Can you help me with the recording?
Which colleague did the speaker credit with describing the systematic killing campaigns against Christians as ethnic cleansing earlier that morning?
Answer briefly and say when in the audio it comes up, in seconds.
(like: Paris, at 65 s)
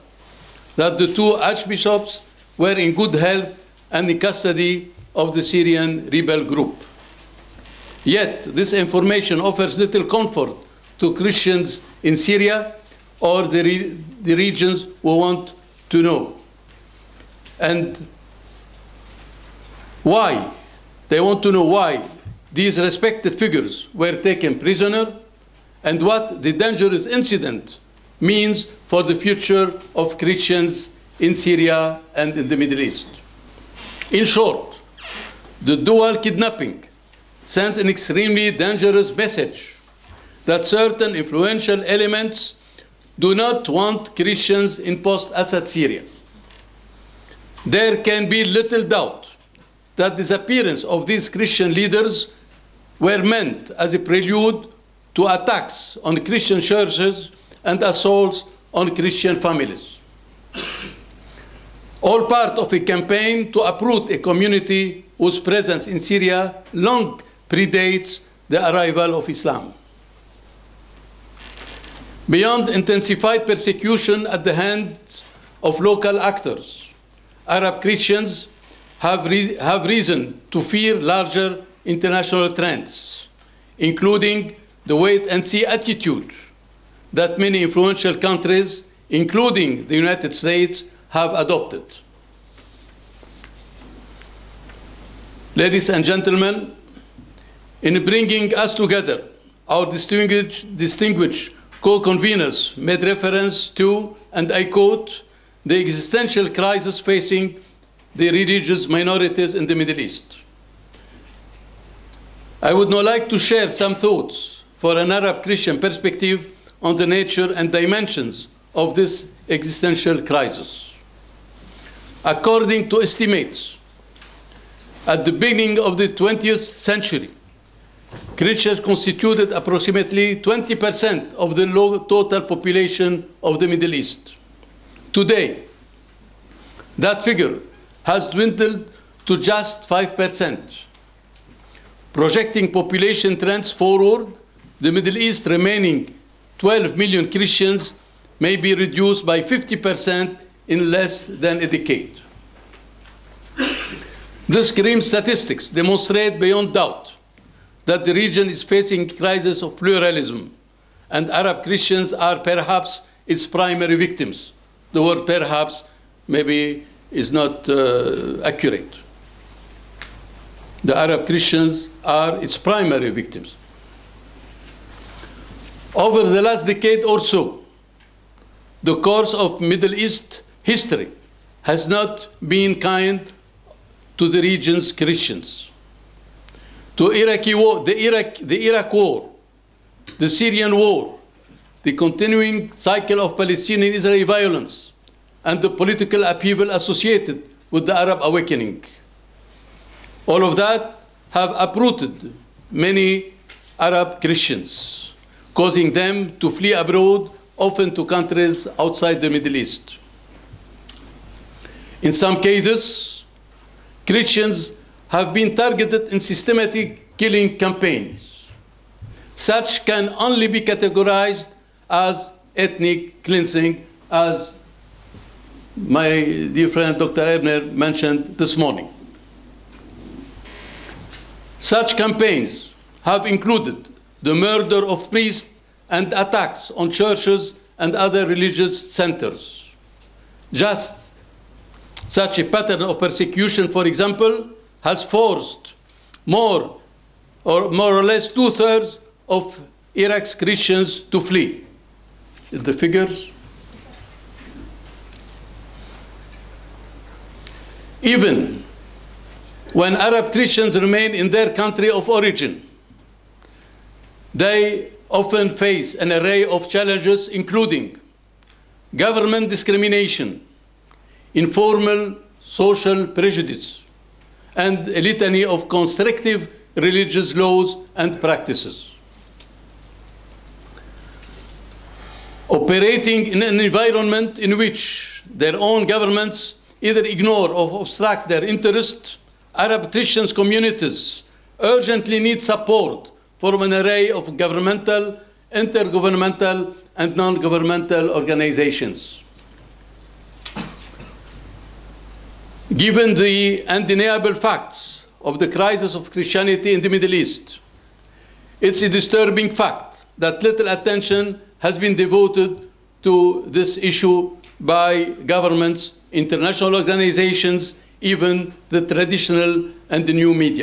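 Dr. Eibner, at 226 s.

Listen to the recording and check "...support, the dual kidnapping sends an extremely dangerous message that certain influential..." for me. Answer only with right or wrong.
wrong.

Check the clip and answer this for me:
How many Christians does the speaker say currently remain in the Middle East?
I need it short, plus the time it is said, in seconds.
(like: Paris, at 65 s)
12 million, at 146 s.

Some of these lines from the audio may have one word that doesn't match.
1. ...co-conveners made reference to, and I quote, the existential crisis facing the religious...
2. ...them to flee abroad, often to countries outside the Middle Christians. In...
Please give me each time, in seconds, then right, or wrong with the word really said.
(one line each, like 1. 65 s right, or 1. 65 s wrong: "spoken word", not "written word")
1. 101 s right
2. 205 s wrong: "East", not "Christians".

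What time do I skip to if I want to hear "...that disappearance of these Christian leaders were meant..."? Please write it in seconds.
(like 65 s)
49 s.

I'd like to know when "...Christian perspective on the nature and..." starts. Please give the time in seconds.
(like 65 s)
115 s.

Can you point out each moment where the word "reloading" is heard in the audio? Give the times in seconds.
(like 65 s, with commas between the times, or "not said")
not said.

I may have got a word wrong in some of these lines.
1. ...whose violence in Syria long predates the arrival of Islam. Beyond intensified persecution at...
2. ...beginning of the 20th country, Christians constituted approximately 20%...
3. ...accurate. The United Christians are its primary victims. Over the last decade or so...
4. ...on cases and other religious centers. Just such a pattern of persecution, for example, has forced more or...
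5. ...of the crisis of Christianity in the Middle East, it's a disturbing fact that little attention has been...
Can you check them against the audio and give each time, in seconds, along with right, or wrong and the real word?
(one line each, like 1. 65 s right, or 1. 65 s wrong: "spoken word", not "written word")
1. 65 s wrong: "presence", not "violence"
2. 125 s wrong: "century", not "country"
3. 168 s wrong: "Arab", not "United"
4. 236 s wrong: "churches", not "cases"
5. 305 s right.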